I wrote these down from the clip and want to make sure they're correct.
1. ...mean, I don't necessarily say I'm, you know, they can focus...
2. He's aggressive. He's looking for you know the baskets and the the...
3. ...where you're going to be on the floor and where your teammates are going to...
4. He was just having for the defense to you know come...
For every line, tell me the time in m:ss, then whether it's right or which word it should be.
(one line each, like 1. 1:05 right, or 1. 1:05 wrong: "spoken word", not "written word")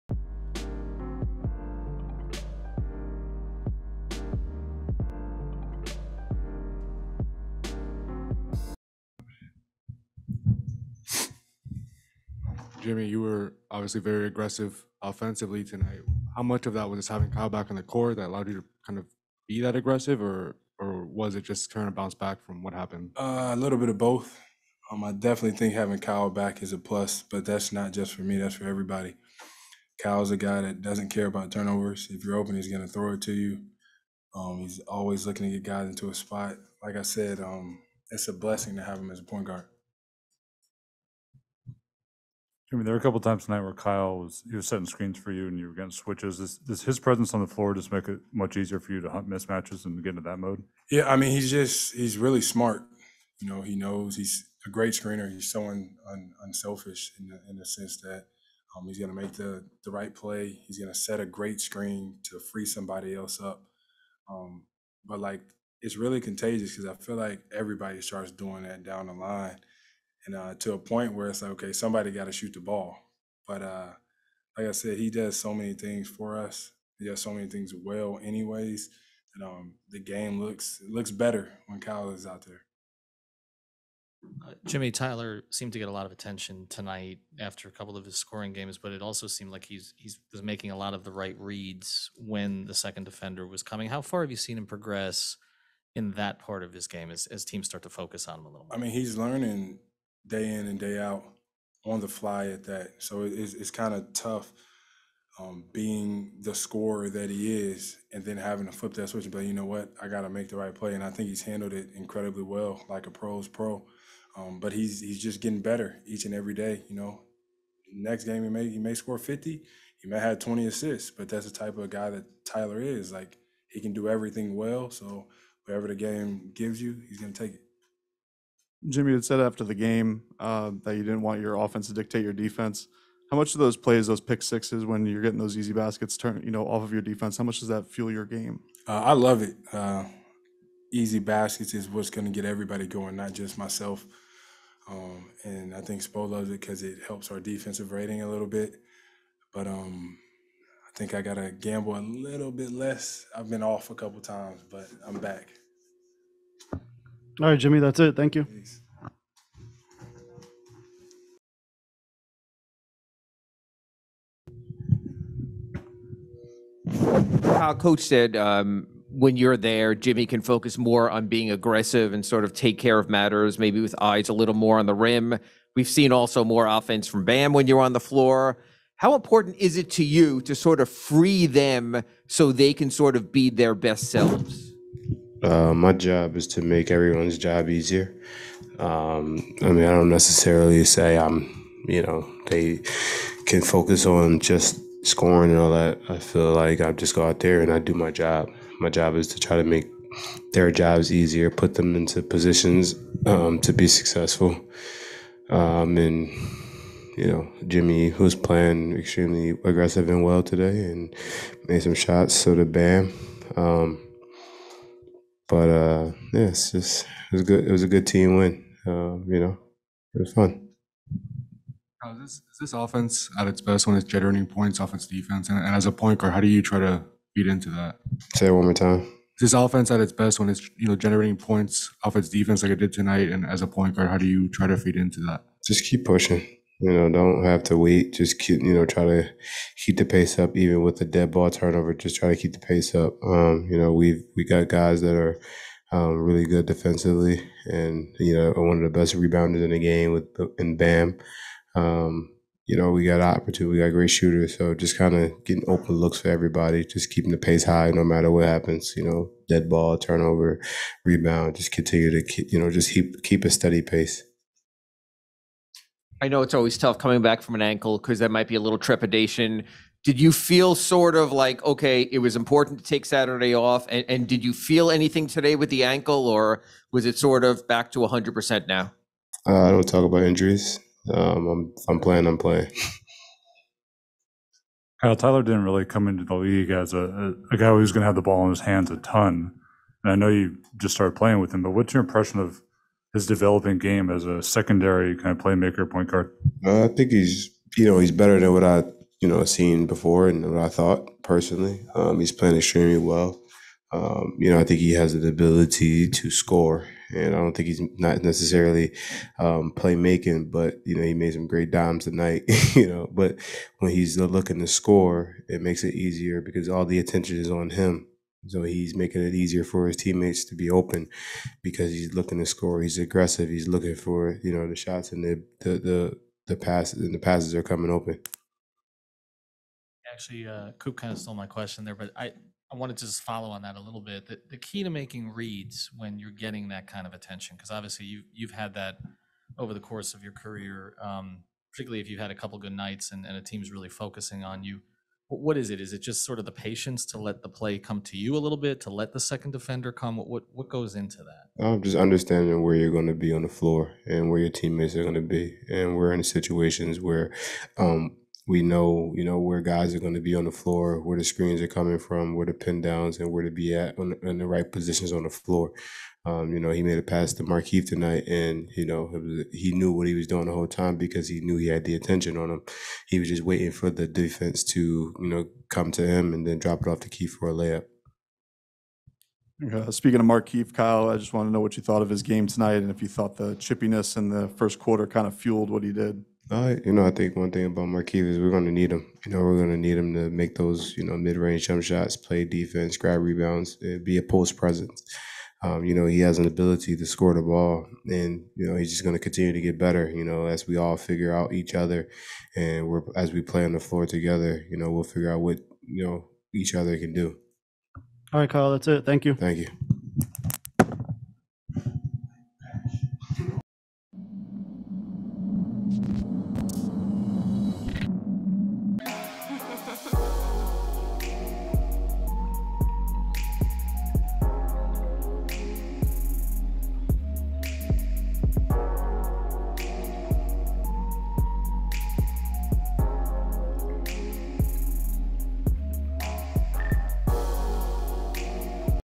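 1. 3:09 right
2. 5:22 wrong: "shots", not "baskets"
3. 5:52 right
4. 6:13 wrong: "waiting", not "having".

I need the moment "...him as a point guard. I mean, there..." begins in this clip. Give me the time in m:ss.
0:38.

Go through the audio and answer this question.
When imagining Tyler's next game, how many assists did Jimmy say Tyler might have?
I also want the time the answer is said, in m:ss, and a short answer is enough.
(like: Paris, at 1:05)
20, at 2:00.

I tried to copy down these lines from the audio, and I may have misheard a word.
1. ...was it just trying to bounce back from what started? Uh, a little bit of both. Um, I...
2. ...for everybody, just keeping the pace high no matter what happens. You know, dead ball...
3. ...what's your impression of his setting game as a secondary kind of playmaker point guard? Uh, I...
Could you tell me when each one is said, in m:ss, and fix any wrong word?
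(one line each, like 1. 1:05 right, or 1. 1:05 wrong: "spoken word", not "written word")
1. 0:21 wrong: "happened", not "started"
2. 4:16 right
3. 4:51 wrong: "developing", not "setting".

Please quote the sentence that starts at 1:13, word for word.
But uh, like I said, he does so many things for us.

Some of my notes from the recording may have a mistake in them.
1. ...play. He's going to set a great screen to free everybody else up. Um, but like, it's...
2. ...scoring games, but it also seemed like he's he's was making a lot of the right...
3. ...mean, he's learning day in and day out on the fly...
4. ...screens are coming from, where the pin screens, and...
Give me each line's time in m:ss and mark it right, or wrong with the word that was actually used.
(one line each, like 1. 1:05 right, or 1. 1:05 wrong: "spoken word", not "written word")
1. 1:00 wrong: "somebody", not "everybody"
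2. 1:28 right
3. 1:38 right
4. 6:01 wrong: "downs", not "screens".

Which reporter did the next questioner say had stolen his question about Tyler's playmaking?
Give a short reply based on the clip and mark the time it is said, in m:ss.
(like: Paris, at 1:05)
Coop, at 5:30.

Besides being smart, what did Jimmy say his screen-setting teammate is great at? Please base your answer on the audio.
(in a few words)
Screener.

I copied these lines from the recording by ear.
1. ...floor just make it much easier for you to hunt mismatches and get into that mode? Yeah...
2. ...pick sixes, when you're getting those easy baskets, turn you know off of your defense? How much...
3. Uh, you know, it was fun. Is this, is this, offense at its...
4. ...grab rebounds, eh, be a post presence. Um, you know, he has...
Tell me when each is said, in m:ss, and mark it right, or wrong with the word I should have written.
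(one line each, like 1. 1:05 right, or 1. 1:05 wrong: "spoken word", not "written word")
1. 0:47 right
2. 2:14 right
3. 3:38 right
4. 6:32 right.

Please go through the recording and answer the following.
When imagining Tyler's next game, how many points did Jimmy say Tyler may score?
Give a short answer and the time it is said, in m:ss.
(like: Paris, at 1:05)
50, at 1:58.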